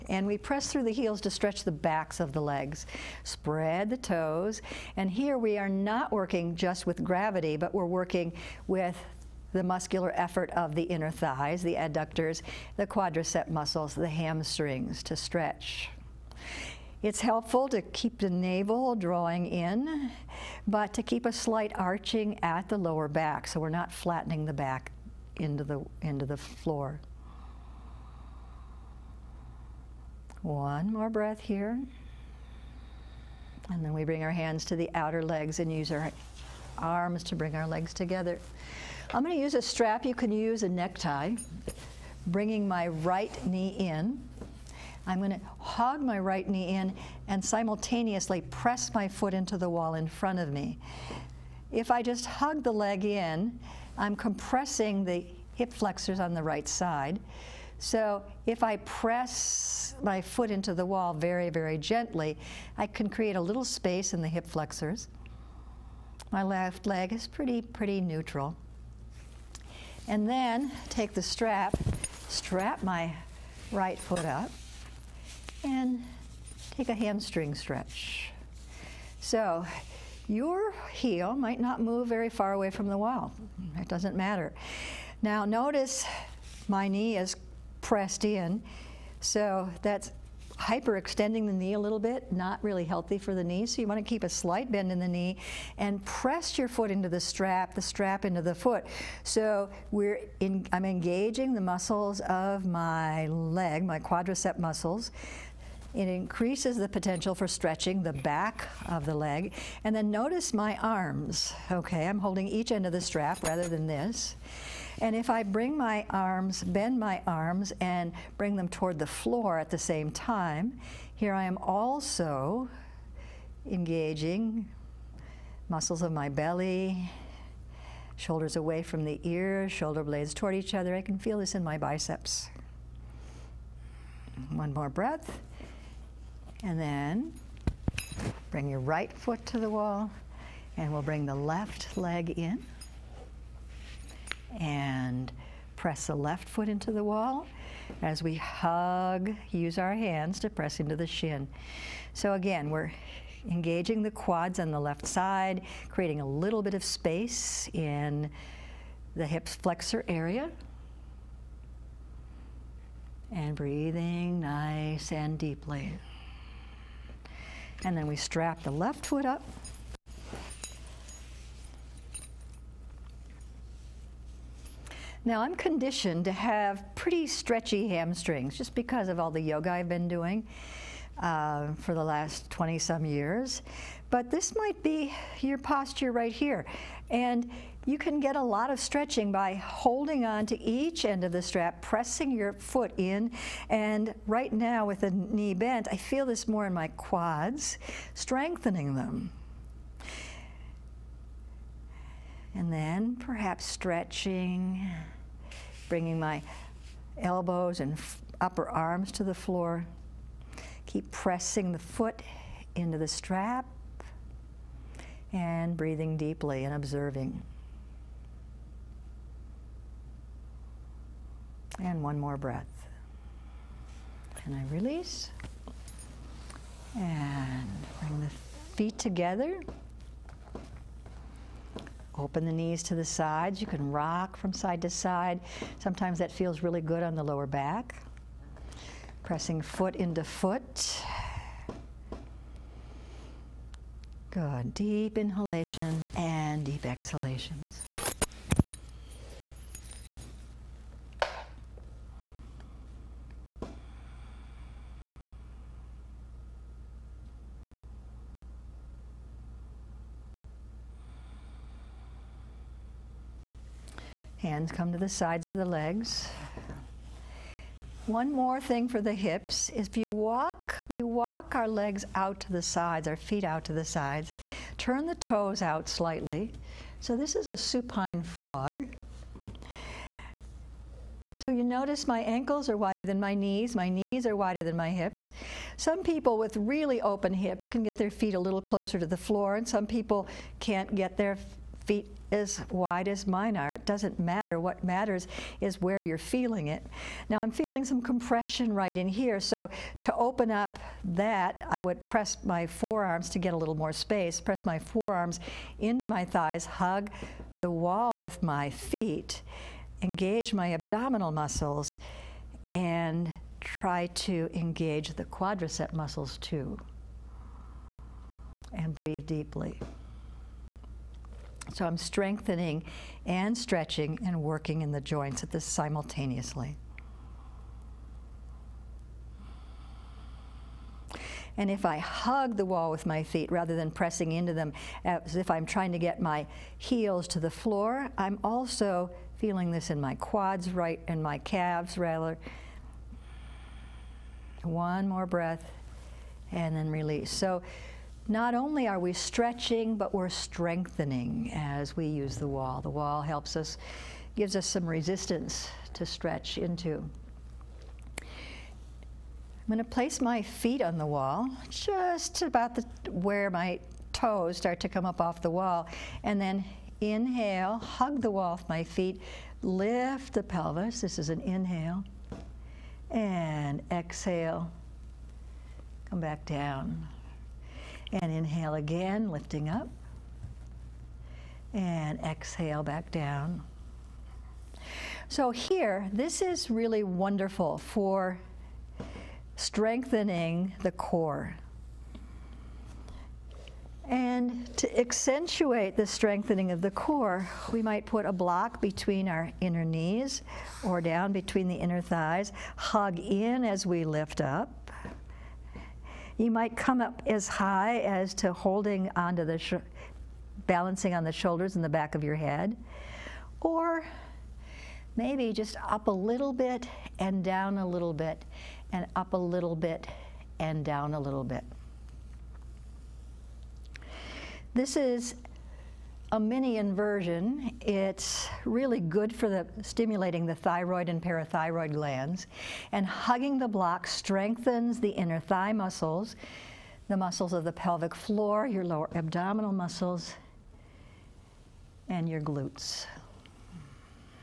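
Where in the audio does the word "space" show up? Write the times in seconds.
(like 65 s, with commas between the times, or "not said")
63 s, 156 s, 303 s.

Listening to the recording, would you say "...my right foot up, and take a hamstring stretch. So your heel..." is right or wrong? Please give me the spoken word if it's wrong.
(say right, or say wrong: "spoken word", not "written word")
right.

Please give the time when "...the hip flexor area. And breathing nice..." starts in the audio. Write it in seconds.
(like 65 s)
159 s.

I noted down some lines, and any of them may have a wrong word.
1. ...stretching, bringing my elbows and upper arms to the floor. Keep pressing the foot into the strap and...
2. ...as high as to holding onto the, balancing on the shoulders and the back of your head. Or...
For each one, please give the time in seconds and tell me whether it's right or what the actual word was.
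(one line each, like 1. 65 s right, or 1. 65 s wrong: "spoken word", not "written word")
1. 203 s right
2. 407 s right.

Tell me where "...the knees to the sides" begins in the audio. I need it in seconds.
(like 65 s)
232 s.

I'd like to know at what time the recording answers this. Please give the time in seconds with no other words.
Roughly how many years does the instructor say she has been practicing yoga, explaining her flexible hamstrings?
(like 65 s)
182 s.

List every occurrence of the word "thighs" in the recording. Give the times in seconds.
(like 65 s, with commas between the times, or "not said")
11 s, 306 s, 402 s, 435 s.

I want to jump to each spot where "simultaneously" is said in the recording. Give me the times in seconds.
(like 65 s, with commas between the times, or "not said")
47 s, 325 s.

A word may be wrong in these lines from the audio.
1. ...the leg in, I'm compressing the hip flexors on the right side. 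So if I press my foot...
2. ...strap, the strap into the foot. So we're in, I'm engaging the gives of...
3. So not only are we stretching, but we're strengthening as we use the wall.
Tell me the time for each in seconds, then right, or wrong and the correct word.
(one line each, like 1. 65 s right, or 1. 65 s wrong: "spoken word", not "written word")
1. 52 s right
2. 97 s wrong: "muscles", not "gives"
3. 347 s right.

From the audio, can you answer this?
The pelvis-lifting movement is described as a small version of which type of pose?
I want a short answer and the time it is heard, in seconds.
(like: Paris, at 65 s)
Mini inversion, at 426 s.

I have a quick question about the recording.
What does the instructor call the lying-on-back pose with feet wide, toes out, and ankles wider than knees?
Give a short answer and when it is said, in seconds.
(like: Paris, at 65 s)
Supine frog, at 277 s.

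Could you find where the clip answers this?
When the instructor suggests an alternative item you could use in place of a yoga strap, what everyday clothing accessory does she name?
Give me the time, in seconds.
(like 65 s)
40 s.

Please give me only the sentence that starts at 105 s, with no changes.
It increases the potential for stretching the back of the leg.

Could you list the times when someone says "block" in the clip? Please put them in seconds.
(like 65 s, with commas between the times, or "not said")
398 s, 433 s.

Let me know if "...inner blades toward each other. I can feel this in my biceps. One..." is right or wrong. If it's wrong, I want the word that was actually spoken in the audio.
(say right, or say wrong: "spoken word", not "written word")
wrong: "shoulder", not "inner".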